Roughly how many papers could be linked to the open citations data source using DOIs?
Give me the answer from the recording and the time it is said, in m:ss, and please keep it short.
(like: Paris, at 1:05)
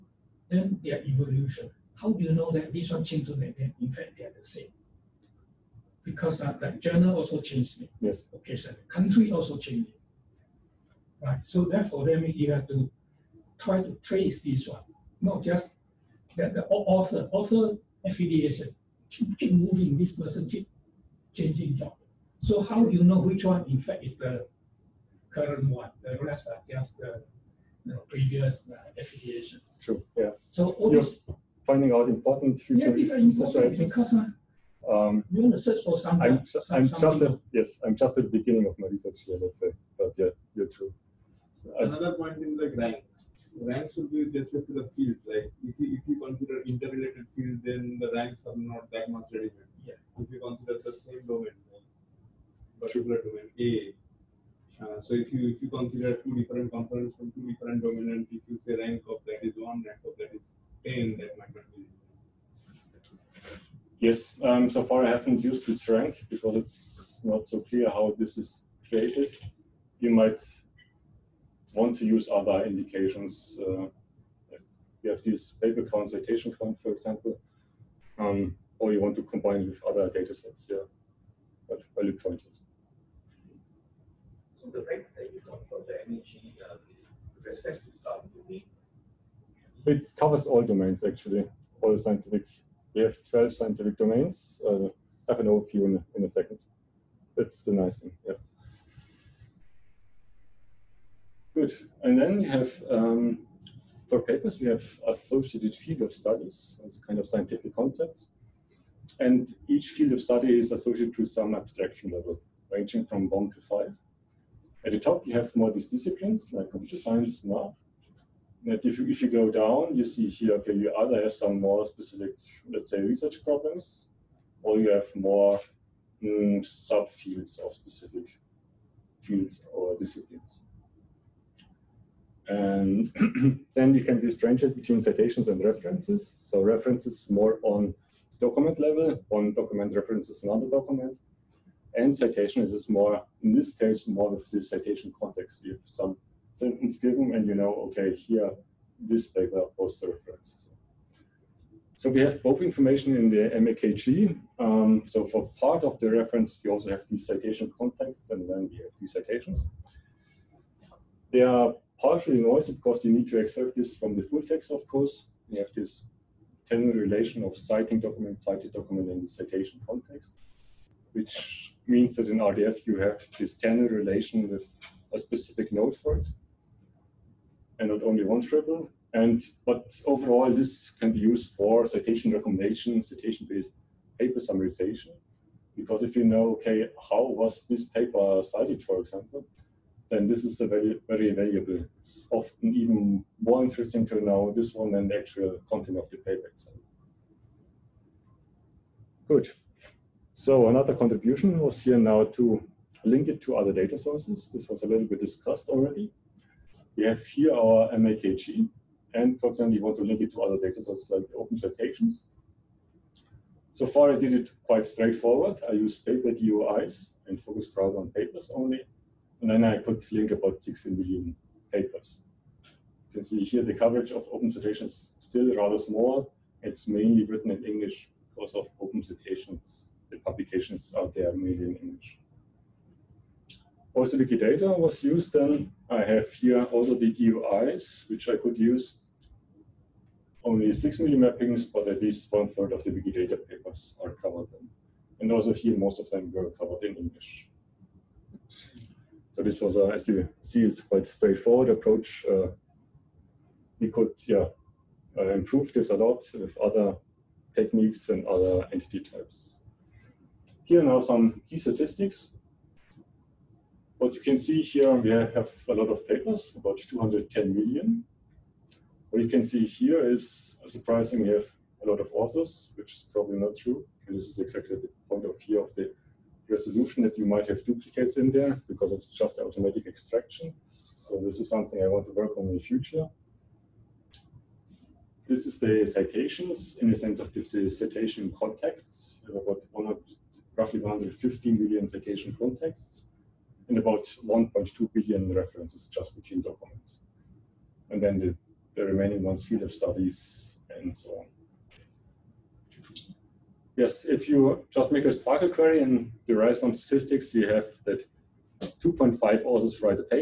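16 million, at 3:40.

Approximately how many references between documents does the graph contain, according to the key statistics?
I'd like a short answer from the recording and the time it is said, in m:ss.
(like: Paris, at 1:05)
1.2 billion, at 4:54.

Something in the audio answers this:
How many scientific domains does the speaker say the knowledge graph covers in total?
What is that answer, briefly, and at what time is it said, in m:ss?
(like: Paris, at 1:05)
12, at 1:33.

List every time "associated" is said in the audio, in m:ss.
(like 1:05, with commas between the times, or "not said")
1:45, 1:50.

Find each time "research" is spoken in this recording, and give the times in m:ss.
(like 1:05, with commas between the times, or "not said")
0:38, 2:02.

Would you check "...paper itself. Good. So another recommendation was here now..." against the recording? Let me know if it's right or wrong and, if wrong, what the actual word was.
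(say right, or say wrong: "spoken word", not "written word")
wrong: "contribution", not "recommendation".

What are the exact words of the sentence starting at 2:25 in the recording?
You have some sentence given and you know, okay, here, this paper was referenced.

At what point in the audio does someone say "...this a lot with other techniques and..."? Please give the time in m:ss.
4:15.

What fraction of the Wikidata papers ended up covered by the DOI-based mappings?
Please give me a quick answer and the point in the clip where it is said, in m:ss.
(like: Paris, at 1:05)
one third, at 4:02.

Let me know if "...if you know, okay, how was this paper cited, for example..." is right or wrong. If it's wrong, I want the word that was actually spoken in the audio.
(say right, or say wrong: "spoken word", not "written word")
right.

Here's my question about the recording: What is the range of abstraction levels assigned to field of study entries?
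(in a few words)
1 to 5.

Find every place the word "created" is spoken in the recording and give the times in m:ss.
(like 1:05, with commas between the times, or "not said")
1:08.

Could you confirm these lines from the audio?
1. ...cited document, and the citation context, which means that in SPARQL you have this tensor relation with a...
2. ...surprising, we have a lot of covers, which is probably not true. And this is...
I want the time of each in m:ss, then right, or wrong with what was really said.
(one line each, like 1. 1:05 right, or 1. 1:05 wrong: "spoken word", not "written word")
1. 2:48 wrong: "RDF", not "SPARQL"
2. 4:30 wrong: "authors", not "covers".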